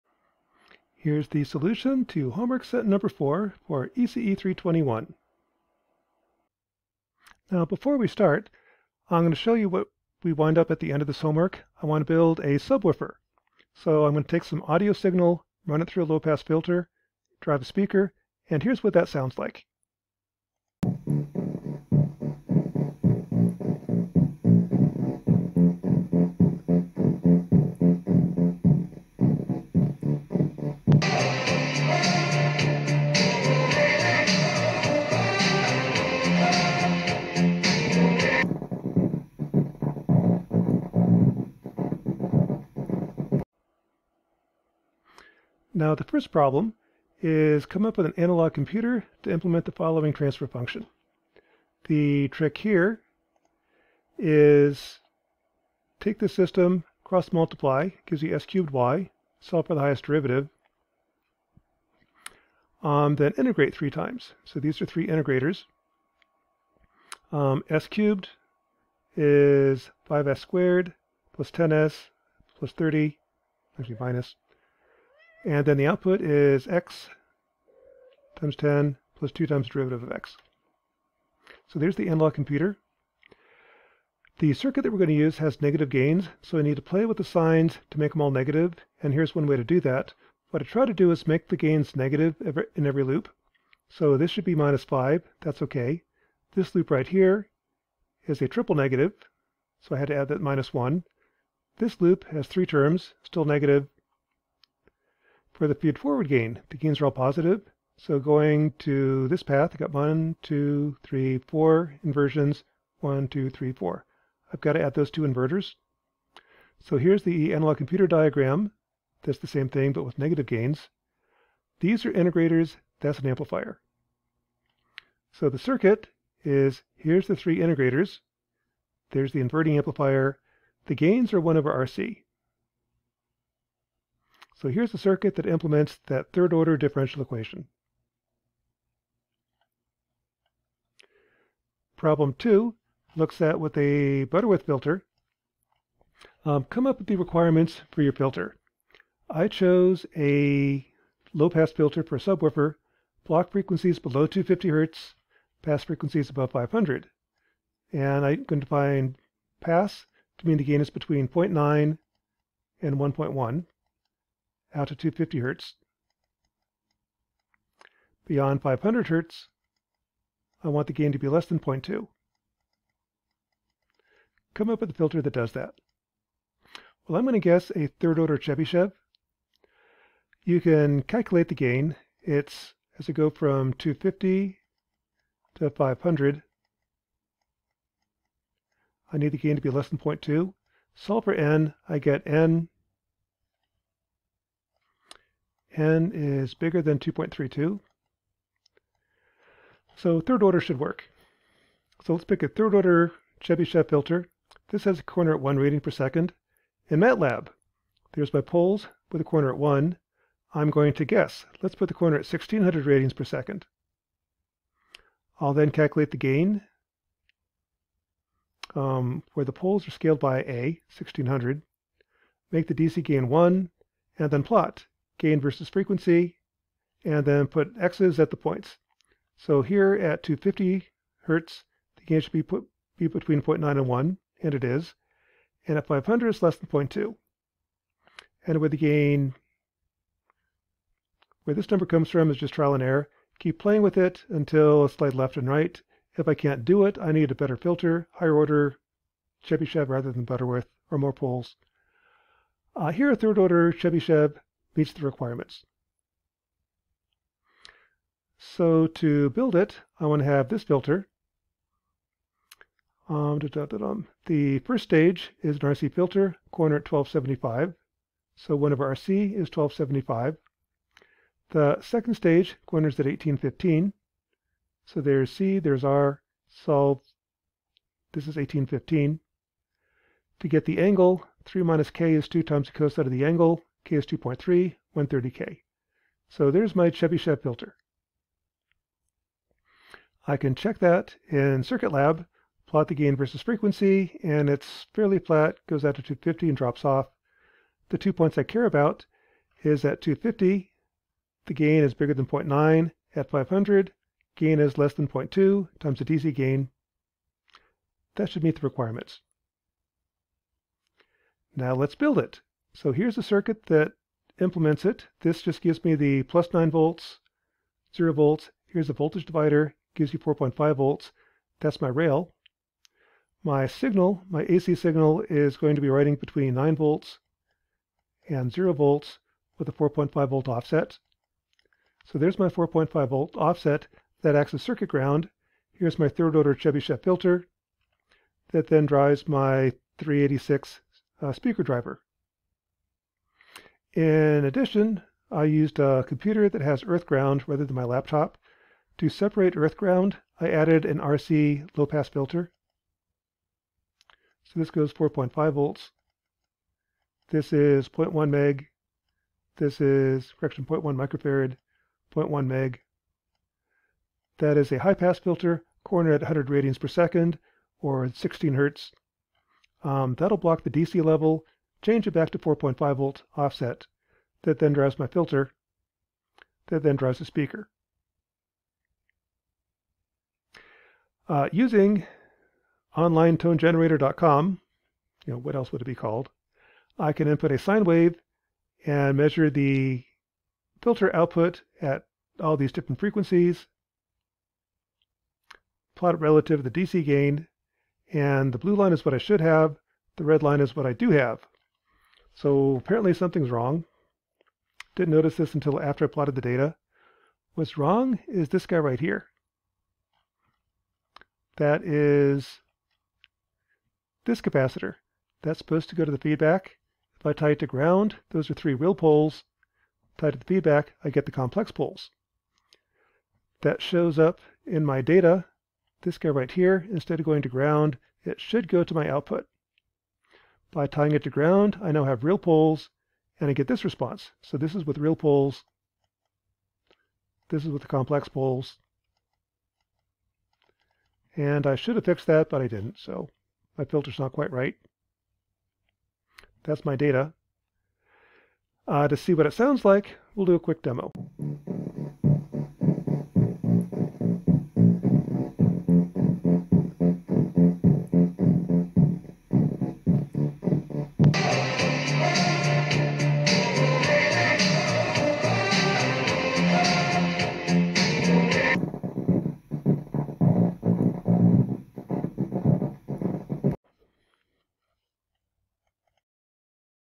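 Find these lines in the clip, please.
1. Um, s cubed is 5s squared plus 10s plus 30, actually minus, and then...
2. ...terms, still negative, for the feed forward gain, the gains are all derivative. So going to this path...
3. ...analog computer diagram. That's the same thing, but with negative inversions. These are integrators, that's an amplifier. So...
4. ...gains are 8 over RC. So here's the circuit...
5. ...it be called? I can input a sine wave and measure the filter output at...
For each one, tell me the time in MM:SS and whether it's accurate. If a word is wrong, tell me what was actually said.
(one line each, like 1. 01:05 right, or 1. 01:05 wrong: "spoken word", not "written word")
1. 01:07 right
2. 01:42 wrong: "positive", not "derivative"
3. 01:57 wrong: "gains", not "inversions"
4. 02:10 wrong: "1", not "8"
5. 06:25 right.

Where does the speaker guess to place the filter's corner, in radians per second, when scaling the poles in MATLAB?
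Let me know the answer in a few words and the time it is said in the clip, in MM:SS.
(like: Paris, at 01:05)
1600, at 03:32.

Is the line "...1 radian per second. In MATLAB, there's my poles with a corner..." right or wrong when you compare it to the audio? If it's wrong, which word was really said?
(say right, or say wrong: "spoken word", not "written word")
right.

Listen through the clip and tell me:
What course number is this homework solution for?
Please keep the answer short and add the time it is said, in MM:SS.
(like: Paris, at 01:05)
ECE 321, at 00:03.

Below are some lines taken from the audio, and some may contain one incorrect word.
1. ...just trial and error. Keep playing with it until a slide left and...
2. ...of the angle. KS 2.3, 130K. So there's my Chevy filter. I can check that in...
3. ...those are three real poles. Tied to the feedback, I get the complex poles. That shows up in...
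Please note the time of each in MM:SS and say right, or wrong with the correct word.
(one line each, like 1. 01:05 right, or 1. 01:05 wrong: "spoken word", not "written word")
1. 04:02 right
2. 04:43 right
3. 06:58 right.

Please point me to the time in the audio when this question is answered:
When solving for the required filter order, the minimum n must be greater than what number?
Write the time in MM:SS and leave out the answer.
03:16.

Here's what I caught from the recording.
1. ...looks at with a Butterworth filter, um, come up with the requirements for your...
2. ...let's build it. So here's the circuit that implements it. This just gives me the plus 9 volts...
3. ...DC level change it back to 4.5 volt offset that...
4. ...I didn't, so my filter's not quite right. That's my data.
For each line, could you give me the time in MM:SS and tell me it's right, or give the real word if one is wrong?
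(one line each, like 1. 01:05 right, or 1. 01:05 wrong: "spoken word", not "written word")
1. 02:23 right
2. 05:11 right
3. 06:10 right
4. 07:22 right.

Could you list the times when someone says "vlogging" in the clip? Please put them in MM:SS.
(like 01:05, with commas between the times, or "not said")
not said.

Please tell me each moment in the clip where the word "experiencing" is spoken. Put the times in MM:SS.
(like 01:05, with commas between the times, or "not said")
not said.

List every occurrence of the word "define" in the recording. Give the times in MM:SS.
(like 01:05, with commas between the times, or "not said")
02:38.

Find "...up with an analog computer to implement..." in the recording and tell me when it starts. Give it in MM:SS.
00:47.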